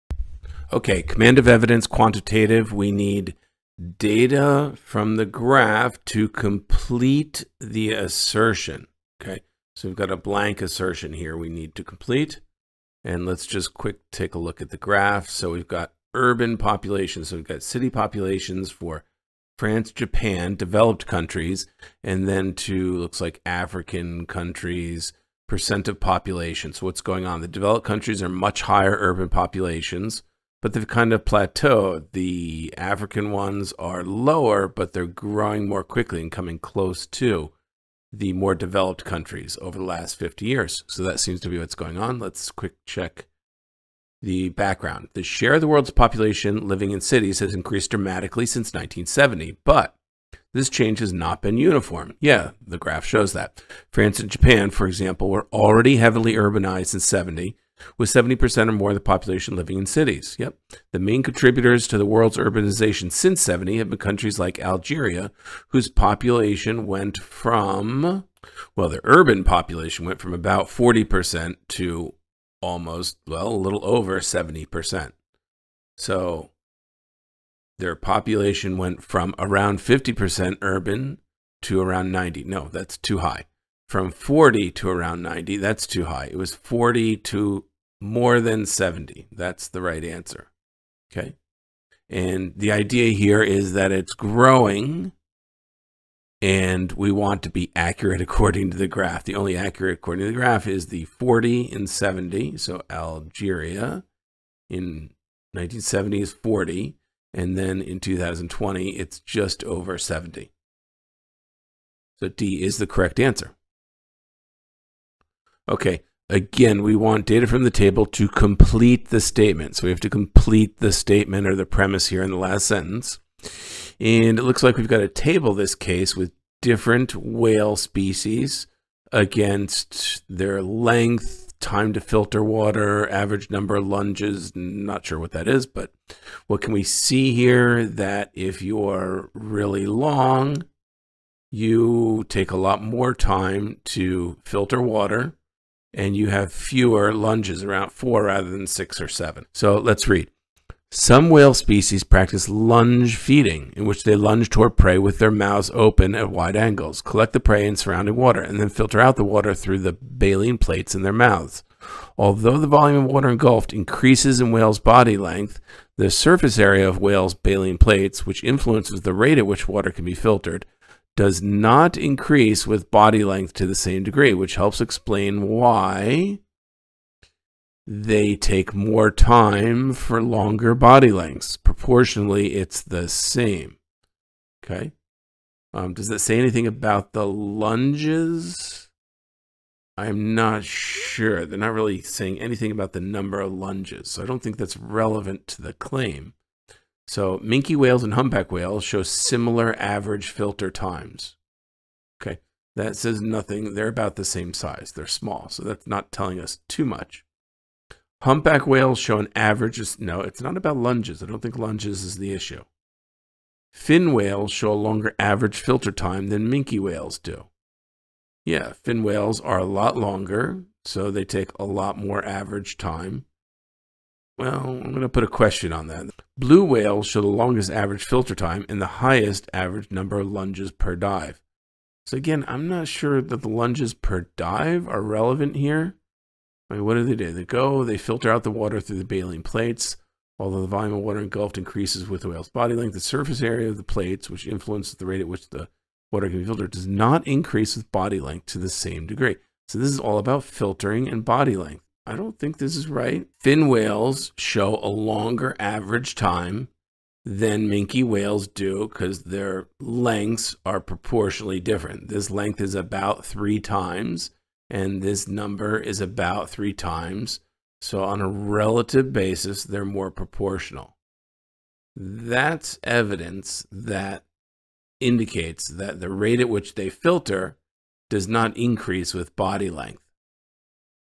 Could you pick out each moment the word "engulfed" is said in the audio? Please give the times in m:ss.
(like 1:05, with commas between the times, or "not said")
2:43, 4:01.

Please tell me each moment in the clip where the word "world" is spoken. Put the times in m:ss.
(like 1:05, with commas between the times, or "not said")
0:45, 1:02.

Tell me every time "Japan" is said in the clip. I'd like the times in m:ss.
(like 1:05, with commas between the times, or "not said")
0:19, 0:54.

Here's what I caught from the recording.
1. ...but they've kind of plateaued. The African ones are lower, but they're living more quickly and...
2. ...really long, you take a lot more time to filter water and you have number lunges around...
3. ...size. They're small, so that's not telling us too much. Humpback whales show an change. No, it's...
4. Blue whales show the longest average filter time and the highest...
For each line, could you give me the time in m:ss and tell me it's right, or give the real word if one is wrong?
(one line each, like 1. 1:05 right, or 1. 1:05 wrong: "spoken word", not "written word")
1. 0:30 wrong: "growing", not "living"
2. 2:19 wrong: "fewer", not "number"
3. 3:24 wrong: "average", not "change"
4. 3:46 right.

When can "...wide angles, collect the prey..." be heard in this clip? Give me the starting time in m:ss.
2:36.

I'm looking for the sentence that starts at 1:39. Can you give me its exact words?
The only accurate according to the graph is the 40 and 70.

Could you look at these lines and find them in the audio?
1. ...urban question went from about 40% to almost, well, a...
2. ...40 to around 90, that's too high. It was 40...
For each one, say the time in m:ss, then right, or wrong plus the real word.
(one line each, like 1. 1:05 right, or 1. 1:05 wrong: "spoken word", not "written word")
1. 1:09 wrong: "population", not "question"
2. 1:24 right.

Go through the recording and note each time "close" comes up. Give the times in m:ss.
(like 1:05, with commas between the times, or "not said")
0:36.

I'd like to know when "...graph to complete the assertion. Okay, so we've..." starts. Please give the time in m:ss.
0:05.